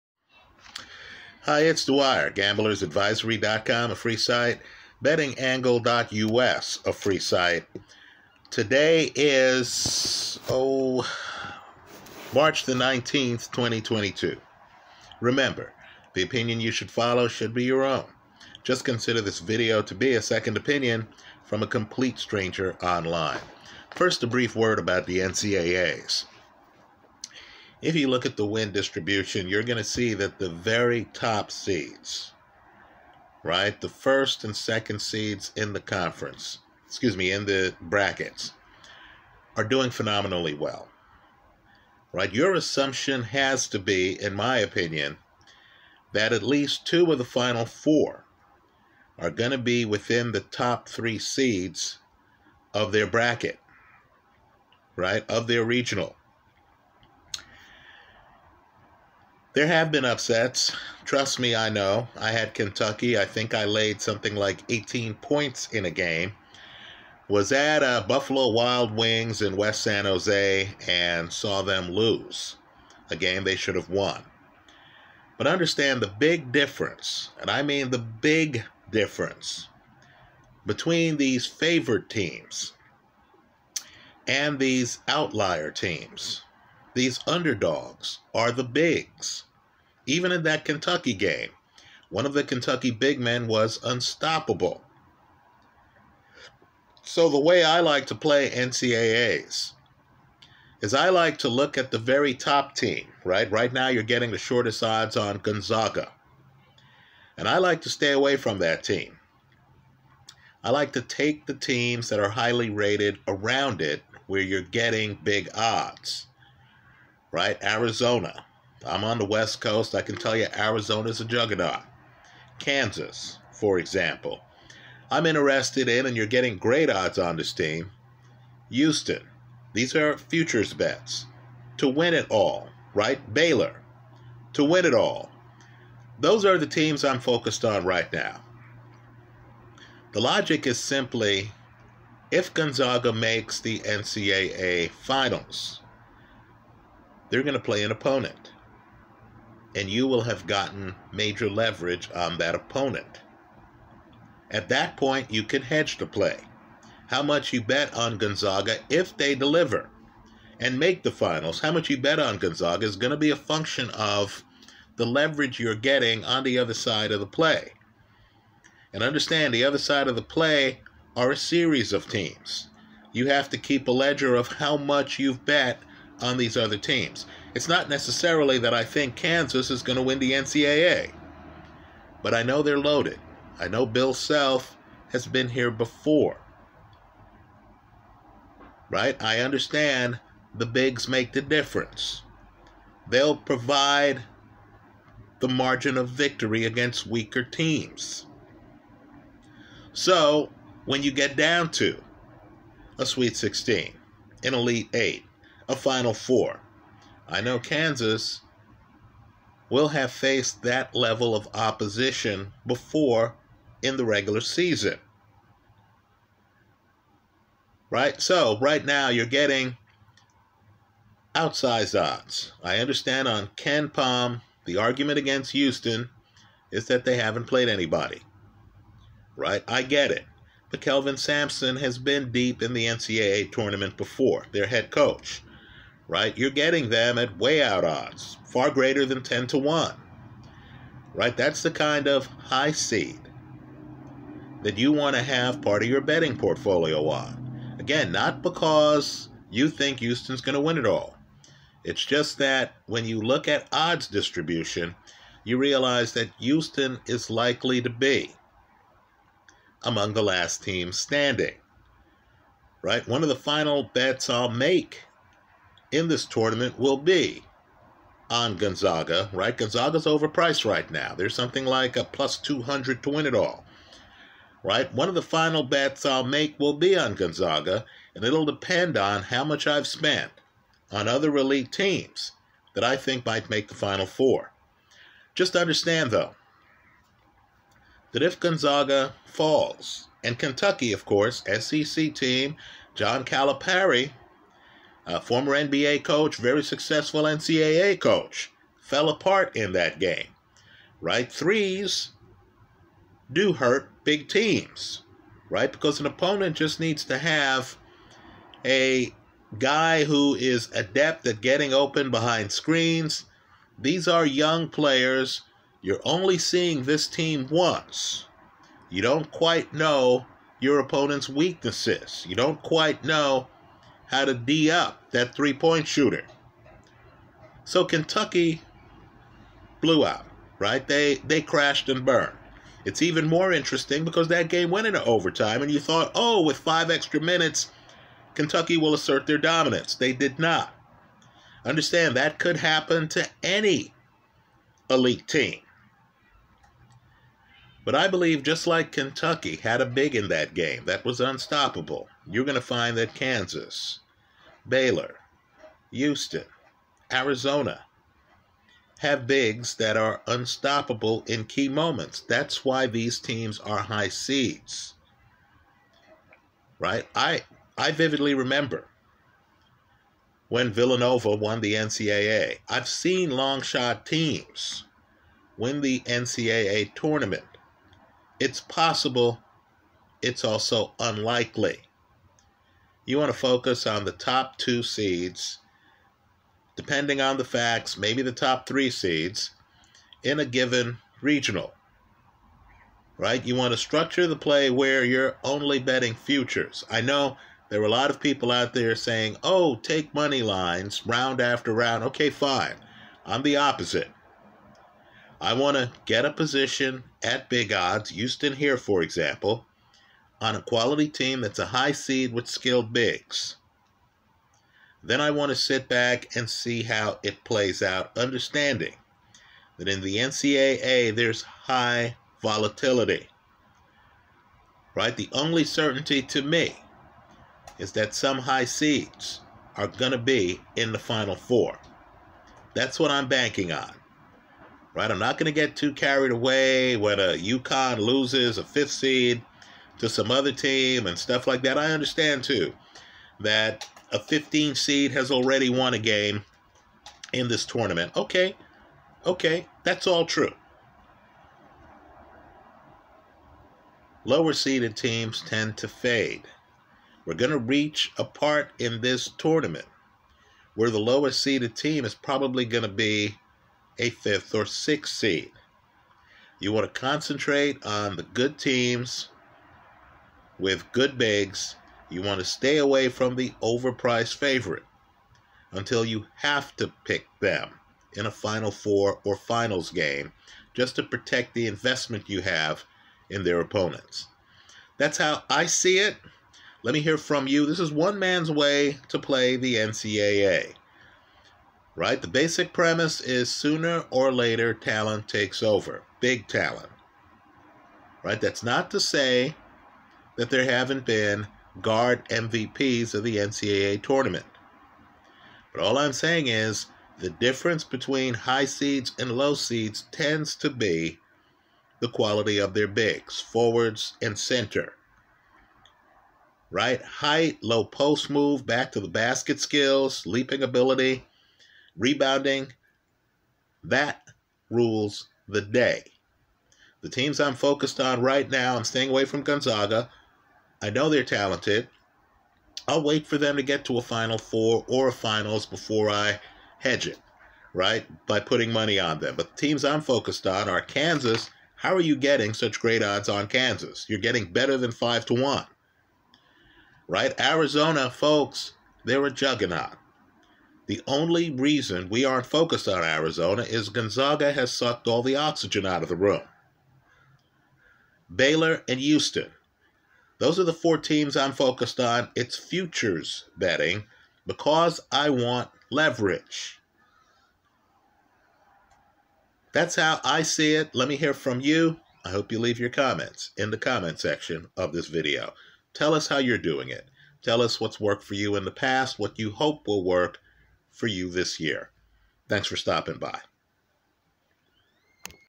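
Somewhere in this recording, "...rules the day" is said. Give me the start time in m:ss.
8:44.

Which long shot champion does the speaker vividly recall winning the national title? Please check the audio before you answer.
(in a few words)
Villanova.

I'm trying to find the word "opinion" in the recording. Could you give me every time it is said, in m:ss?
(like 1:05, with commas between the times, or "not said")
0:16, 0:20, 0:44.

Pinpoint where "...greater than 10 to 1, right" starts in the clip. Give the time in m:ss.
3:58.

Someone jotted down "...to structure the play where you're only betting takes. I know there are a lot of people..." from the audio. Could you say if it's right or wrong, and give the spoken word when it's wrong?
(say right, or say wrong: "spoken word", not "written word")
wrong: "futures", not "takes".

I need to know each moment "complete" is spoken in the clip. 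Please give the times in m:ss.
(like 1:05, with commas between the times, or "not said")
0:21.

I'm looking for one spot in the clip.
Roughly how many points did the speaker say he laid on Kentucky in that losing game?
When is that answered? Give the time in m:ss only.
1:04.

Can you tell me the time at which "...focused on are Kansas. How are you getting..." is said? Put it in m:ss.
9:00.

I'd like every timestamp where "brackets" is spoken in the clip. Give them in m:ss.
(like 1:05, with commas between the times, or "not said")
0:37, 0:53.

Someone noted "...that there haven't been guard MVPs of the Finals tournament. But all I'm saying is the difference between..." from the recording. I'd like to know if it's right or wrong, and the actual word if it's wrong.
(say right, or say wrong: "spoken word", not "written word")
wrong: "NCAA", not "Finals".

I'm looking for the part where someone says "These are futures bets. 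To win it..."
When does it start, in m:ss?
2:09.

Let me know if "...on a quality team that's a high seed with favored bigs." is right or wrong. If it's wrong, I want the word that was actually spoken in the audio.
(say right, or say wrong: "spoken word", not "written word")
wrong: "skilled", not "favored".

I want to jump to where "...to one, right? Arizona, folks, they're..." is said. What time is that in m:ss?
9:05.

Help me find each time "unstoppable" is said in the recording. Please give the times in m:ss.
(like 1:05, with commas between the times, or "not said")
1:33, 5:51, 6:00.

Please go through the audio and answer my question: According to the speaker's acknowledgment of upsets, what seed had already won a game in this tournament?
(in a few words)
15.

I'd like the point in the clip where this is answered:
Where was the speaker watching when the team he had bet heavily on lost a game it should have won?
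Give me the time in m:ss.
1:08.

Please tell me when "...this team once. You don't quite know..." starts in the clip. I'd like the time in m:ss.
5:16.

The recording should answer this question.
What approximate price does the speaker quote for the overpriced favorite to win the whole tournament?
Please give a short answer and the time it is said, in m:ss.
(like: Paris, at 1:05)
+200, at 4:32.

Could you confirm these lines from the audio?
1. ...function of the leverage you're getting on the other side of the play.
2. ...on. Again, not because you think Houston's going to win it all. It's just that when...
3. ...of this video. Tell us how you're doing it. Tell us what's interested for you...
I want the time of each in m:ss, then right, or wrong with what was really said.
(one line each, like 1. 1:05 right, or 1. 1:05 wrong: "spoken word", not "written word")
1. 2:43 right
2. 4:07 right
3. 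9:34 wrong: "worked", not "interested".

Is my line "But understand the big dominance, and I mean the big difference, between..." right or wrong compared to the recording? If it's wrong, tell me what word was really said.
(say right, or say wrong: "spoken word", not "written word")
wrong: "difference", not "dominance".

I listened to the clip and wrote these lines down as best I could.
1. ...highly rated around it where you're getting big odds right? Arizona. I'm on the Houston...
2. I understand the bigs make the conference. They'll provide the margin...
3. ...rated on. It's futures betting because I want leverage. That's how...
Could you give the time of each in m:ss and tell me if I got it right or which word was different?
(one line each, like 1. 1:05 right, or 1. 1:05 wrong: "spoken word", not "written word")
1. 1:52 wrong: "West", not "Houston"
2. 3:09 wrong: "difference", not "conference"
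3. 9:21 wrong: "focused", not "rated".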